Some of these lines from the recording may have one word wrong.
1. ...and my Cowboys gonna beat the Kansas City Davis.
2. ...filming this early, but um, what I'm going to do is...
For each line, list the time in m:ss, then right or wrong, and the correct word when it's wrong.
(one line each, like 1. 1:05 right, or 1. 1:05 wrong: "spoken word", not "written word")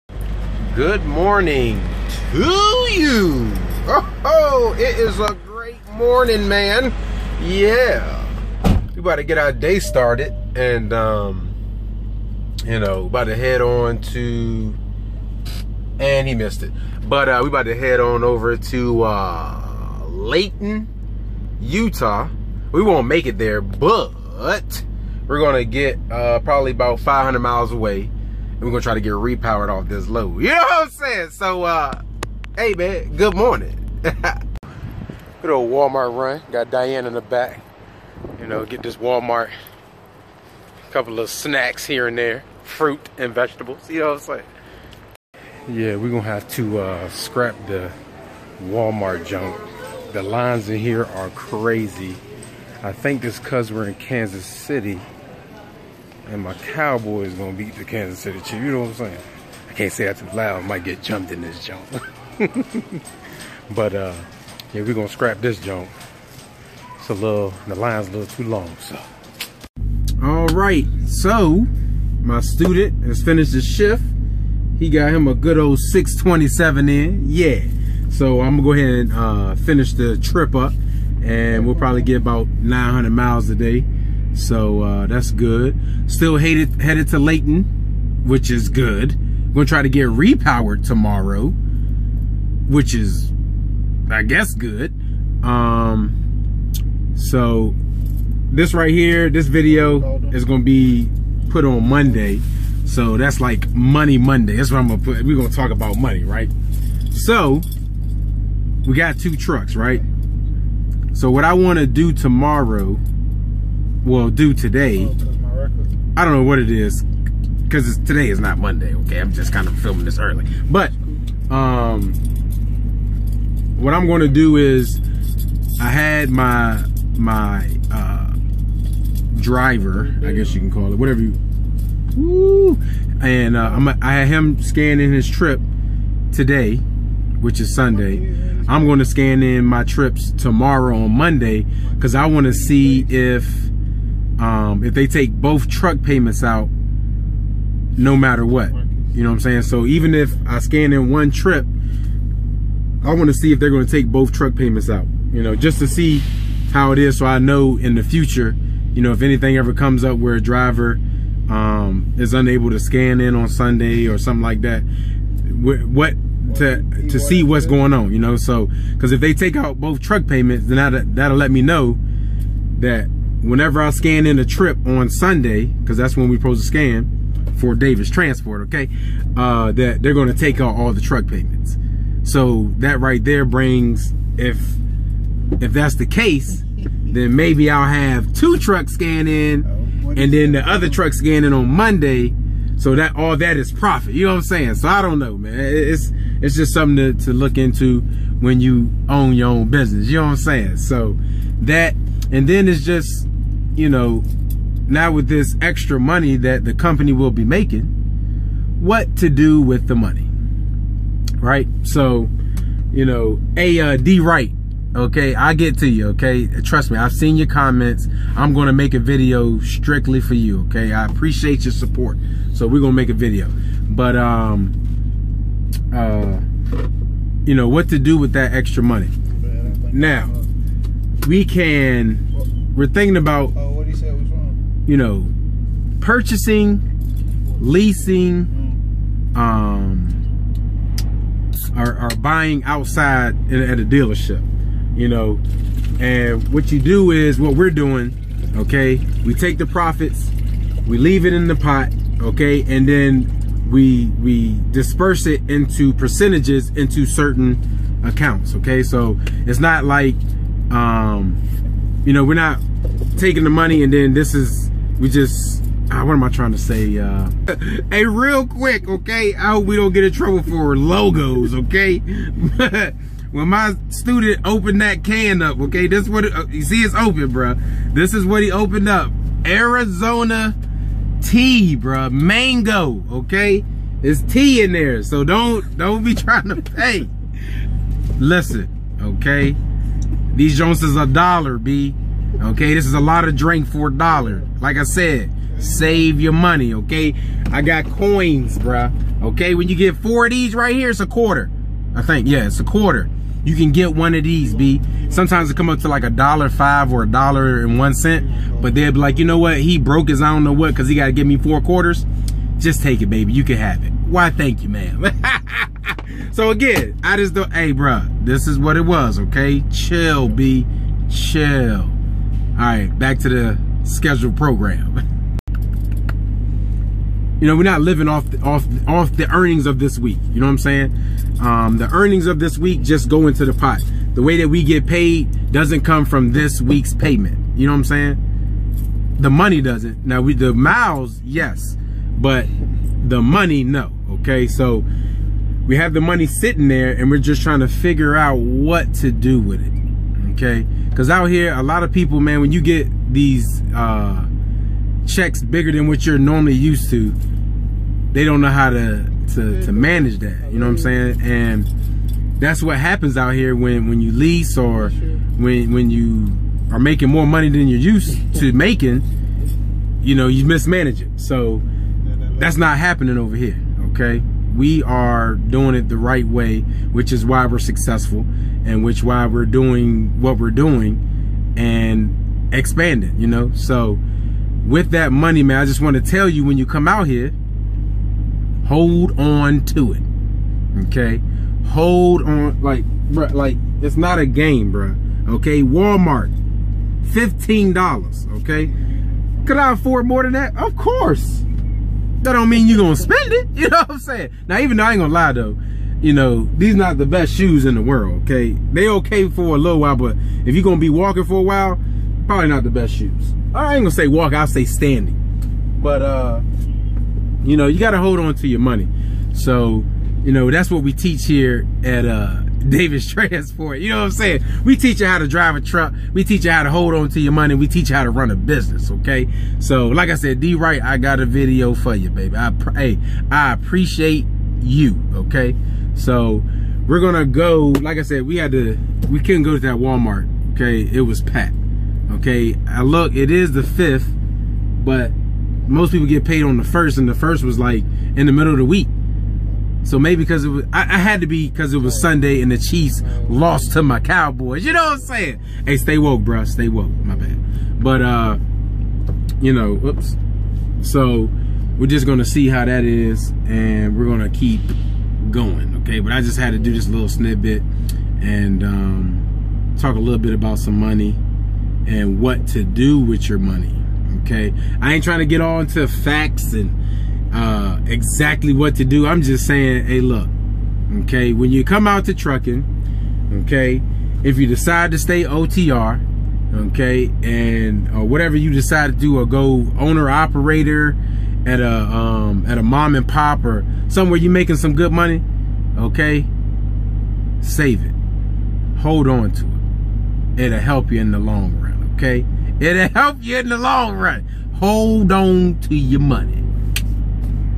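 1. 0:56 wrong: "Chiefs", not "Davis"
2. 1:59 right.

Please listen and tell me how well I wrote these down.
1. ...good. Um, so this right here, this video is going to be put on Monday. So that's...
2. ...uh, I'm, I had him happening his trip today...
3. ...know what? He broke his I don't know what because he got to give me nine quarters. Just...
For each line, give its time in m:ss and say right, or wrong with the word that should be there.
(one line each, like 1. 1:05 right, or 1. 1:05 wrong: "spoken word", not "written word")
1. 1:34 right
2. 2:13 wrong: "scanning", not "happening"
3. 5:09 wrong: "four", not "nine".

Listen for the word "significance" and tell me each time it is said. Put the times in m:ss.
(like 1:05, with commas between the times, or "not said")
not said.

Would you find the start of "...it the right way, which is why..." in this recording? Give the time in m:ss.
6:15.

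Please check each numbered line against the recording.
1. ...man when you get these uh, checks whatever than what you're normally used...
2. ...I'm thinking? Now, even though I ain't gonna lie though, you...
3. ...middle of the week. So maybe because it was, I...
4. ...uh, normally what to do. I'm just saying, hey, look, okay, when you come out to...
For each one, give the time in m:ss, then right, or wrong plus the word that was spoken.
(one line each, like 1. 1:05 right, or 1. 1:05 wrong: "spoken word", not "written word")
1. 5:52 wrong: "bigger", not "whatever"
2. 6:43 wrong: "saying", not "thinking"
3. 7:28 right
4. 7:57 wrong: "exactly", not "normally".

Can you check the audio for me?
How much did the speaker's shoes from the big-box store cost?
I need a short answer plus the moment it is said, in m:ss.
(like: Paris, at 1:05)
$15, at 6:37.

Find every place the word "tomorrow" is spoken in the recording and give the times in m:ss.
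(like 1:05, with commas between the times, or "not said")
1:30, 1:52, 2:20.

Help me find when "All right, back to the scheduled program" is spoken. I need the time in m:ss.
5:21.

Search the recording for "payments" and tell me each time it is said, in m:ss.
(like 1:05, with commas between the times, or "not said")
2:26, 2:34, 2:50, 3:01, 5:36.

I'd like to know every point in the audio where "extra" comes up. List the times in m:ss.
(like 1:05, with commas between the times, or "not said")
3:25, 3:48.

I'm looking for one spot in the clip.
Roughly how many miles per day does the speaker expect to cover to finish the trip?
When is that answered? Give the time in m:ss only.
1:22.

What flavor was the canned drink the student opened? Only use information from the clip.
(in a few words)
Mango.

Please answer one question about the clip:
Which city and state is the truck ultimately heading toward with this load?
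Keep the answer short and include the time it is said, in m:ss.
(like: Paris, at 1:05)
Layton, Utah, at 0:20.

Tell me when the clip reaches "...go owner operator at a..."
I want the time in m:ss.
8:09.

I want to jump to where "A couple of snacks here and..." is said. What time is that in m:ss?
0:40.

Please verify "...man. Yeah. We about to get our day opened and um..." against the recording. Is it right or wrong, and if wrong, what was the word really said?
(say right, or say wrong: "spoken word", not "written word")
wrong: "started", not "opened".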